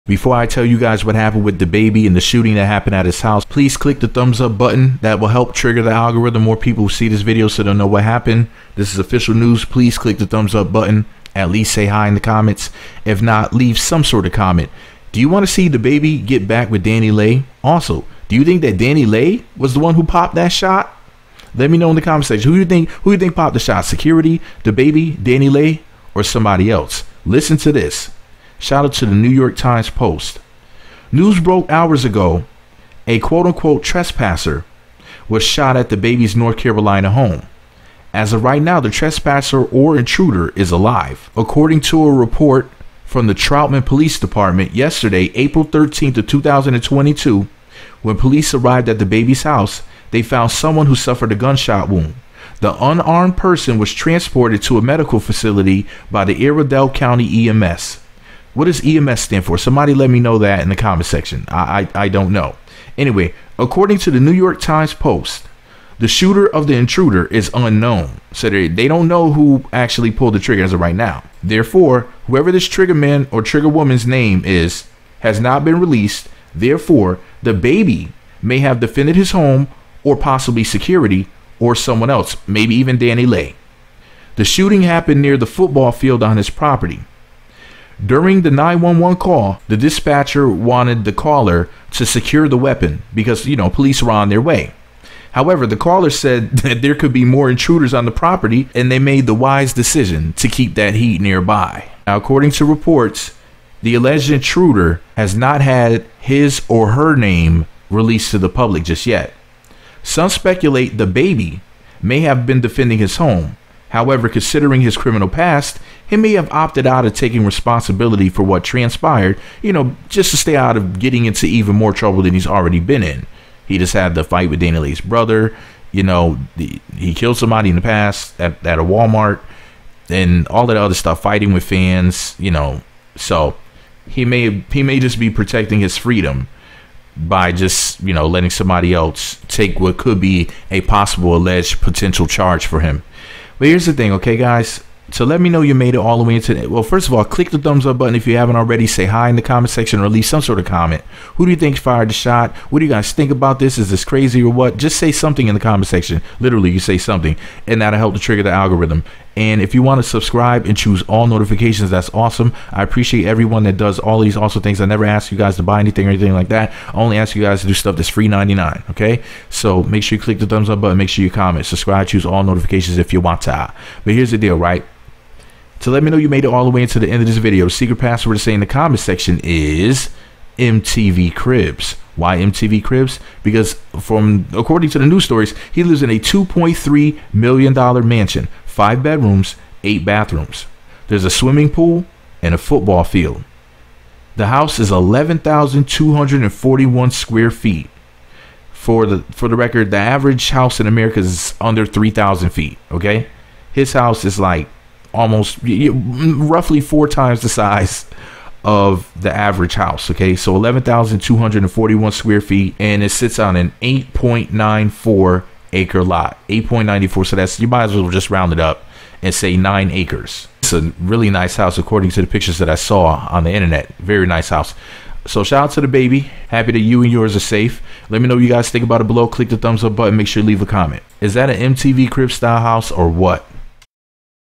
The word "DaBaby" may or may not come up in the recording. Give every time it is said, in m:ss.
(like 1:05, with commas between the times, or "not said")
0:01, 0:15, 0:24, 0:35, 0:48, 1:17, 1:50, 3:45.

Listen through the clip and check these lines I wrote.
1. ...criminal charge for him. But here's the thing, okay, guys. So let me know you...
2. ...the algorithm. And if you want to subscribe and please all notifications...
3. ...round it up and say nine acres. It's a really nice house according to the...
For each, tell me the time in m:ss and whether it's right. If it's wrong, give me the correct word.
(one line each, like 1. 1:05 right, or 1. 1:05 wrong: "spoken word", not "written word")
1. 2:21 wrong: "potential", not "criminal"
2. 2:38 wrong: "choose", not "please"
3. 3:38 right.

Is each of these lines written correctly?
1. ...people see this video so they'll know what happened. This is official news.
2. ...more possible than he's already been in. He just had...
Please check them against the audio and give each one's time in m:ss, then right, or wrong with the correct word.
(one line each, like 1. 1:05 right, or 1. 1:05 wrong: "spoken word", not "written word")
1. 0:06 right
2. 2:01 wrong: "trouble", not "possible".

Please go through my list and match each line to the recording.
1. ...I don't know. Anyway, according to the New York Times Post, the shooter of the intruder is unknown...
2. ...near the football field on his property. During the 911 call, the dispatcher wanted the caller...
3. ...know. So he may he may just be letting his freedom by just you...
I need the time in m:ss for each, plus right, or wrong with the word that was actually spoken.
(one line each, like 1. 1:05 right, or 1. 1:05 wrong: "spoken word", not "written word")
1. 1:02 right
2. 1:25 right
3. 2:12 wrong: "protecting", not "letting".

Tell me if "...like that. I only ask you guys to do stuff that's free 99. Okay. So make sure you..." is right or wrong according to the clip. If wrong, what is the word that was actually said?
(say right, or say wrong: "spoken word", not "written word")
right.